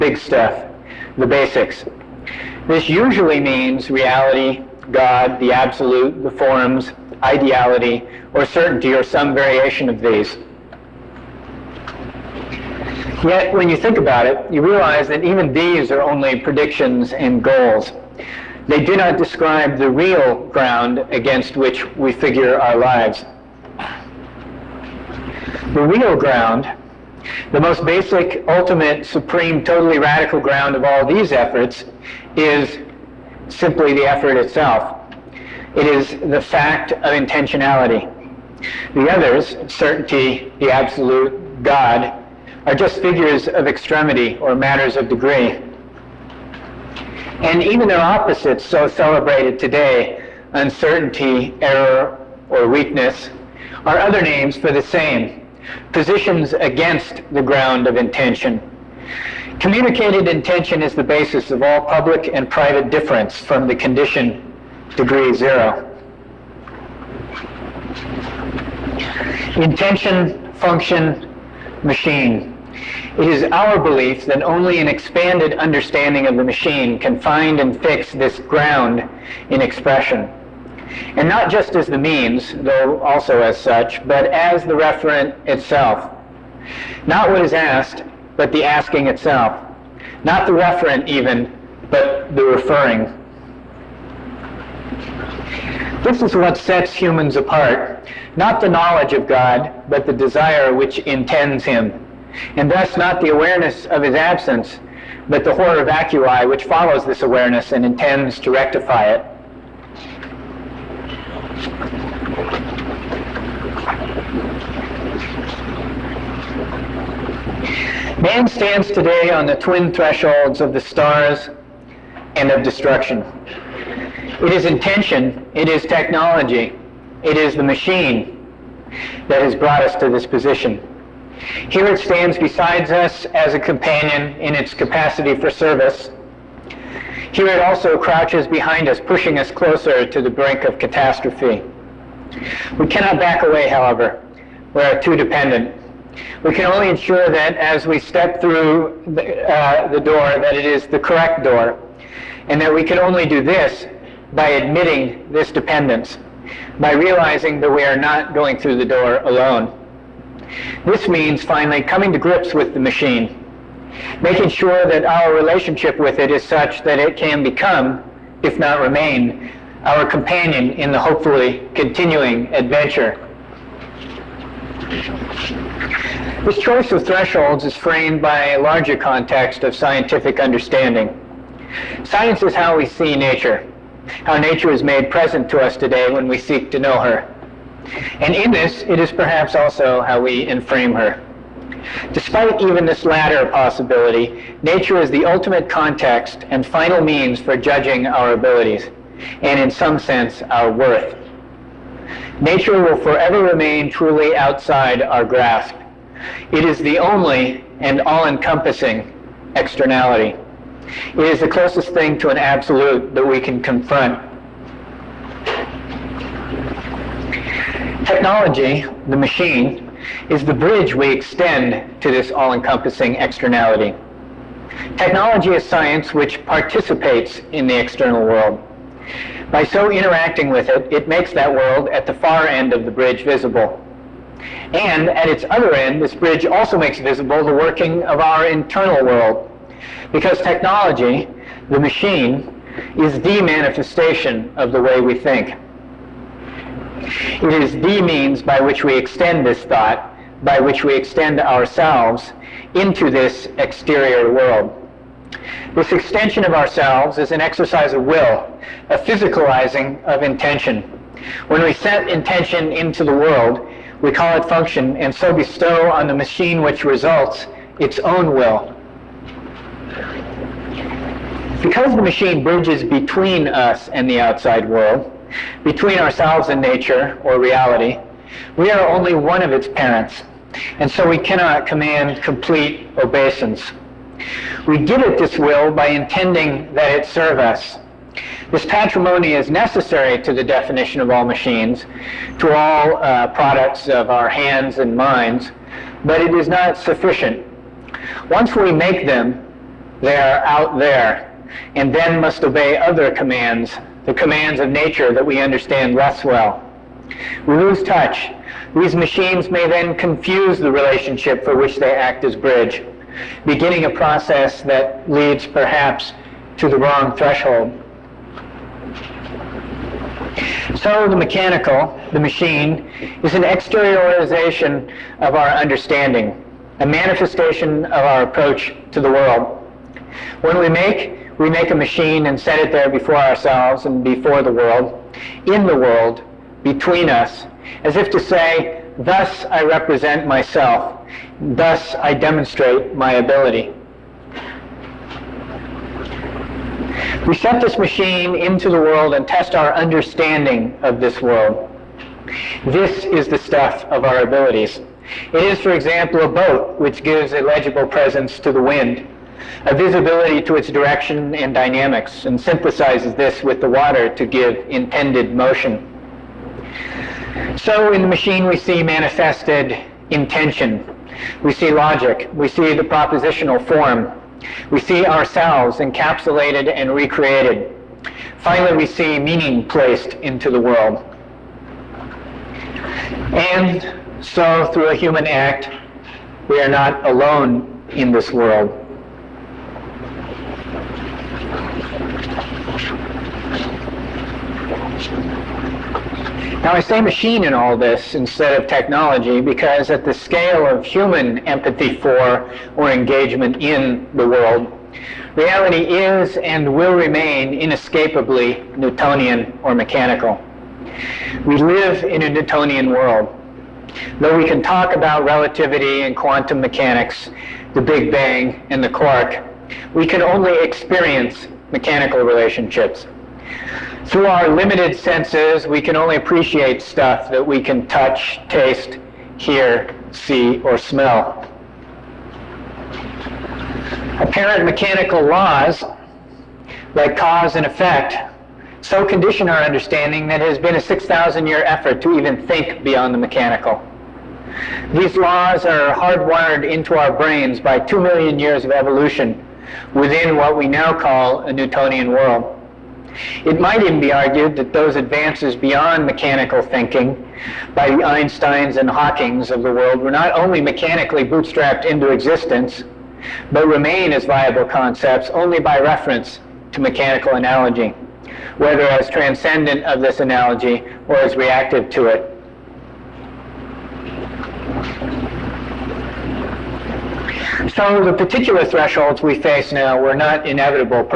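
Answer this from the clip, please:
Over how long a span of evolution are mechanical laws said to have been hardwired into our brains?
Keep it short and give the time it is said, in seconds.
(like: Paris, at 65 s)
2 million years, at 447 s.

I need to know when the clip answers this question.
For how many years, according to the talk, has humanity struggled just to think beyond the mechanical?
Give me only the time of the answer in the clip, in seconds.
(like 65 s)
440 s.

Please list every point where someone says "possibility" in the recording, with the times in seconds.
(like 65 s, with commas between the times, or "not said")
193 s.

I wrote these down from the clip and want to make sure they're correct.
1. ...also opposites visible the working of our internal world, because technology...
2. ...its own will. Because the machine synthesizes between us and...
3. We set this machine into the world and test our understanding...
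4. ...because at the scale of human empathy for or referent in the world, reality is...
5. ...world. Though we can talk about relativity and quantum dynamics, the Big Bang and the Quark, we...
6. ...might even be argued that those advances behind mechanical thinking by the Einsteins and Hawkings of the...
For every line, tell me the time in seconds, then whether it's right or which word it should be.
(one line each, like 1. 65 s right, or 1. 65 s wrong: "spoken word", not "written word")
1. 236 s wrong: "makes", not "opposites"
2. 267 s wrong: "bridges", not "synthesizes"
3. 347 s right
4. 399 s wrong: "engagement", not "referent"
5. 412 s wrong: "mechanics", not "dynamics"
6. 453 s wrong: "beyond", not "behind".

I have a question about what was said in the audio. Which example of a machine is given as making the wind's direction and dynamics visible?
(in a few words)
a boat.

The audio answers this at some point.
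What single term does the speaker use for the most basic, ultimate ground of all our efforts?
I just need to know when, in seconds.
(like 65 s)
37 s.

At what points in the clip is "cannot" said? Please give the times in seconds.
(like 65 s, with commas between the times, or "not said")
142 s, 281 s.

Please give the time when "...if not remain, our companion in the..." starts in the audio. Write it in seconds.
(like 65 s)
168 s.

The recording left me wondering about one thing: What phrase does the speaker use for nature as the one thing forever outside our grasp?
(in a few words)
the only and all-encompassing externality.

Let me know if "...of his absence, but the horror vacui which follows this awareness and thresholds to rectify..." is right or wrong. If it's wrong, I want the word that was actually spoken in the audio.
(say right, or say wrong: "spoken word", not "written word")
wrong: "intends", not "thresholds".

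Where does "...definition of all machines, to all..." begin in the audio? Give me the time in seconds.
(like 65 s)
290 s.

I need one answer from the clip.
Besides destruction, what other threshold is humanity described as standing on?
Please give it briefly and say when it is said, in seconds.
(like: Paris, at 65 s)
the stars, at 120 s.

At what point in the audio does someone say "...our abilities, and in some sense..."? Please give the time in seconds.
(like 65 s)
198 s.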